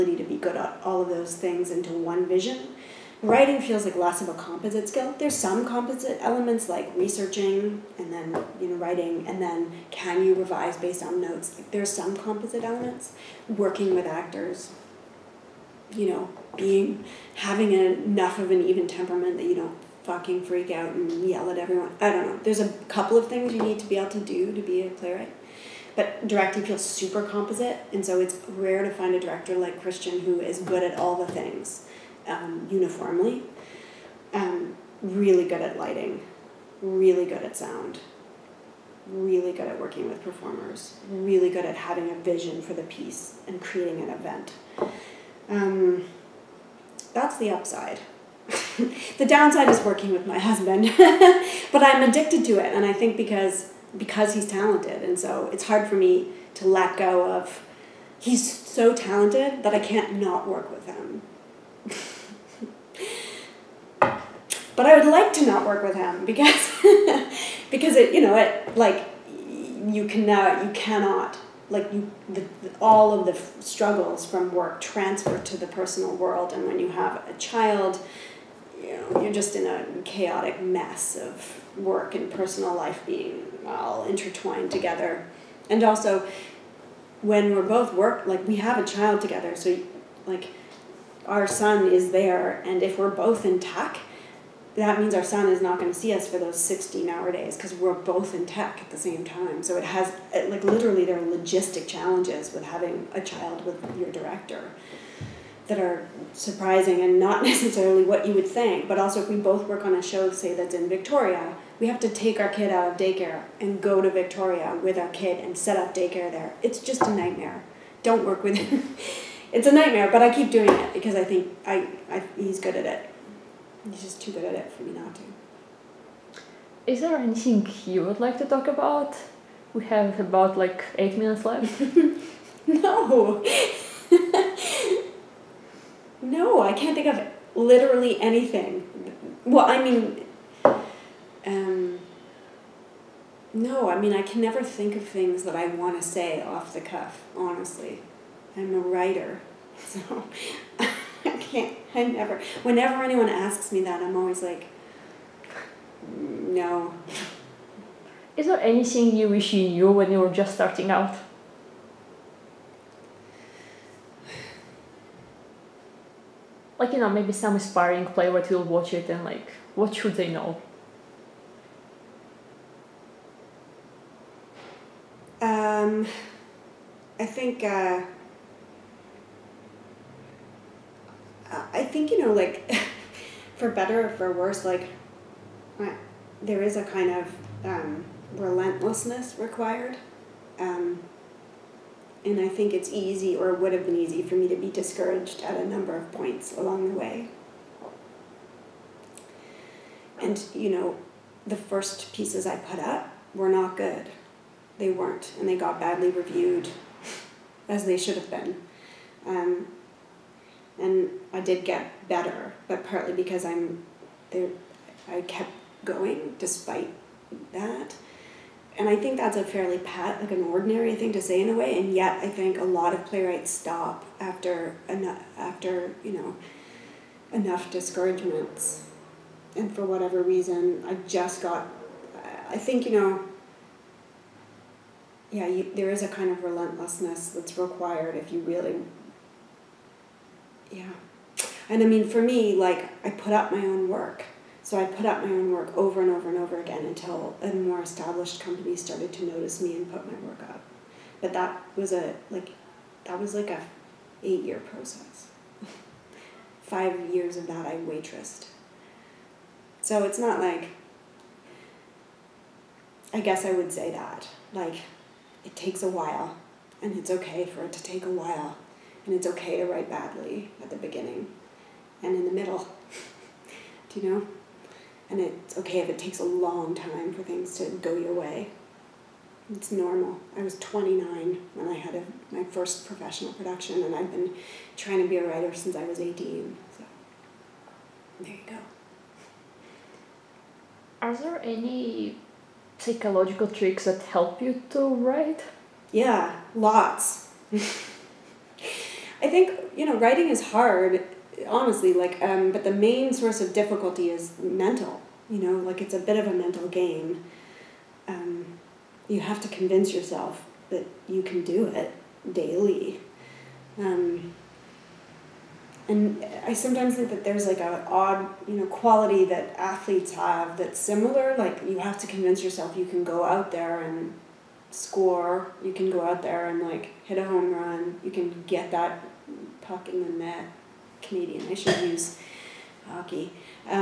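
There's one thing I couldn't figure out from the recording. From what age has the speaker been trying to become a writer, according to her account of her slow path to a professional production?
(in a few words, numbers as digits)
18.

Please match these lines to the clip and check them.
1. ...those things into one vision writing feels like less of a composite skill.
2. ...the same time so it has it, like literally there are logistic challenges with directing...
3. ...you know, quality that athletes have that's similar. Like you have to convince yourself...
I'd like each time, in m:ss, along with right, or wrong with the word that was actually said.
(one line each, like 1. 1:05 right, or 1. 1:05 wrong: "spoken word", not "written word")
1. 0:01 right
2. 1:38 wrong: "having", not "directing"
3. 5:18 right.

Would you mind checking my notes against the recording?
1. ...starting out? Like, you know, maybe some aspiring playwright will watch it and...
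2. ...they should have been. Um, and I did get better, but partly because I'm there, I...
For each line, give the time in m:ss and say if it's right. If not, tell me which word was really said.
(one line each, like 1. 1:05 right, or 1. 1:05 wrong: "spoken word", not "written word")
1. 2:40 right
2. 3:27 right.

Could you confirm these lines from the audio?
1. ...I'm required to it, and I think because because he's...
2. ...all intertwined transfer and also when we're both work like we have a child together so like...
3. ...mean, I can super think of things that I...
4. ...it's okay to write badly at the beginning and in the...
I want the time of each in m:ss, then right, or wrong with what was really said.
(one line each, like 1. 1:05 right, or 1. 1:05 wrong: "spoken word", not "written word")
1. 0:51 wrong: "addicted", not "required"
2. 1:23 wrong: "together", not "transfer"
3. 2:23 wrong: "never", not "super"
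4. 4:29 right.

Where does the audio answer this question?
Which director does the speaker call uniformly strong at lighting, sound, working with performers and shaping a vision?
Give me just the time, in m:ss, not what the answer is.
0:29.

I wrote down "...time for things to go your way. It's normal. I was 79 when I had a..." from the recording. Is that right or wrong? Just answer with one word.
wrong.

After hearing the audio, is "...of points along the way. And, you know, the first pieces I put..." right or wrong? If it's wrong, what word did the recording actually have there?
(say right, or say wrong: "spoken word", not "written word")
right.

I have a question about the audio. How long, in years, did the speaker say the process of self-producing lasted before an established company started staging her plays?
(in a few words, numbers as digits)
8 years.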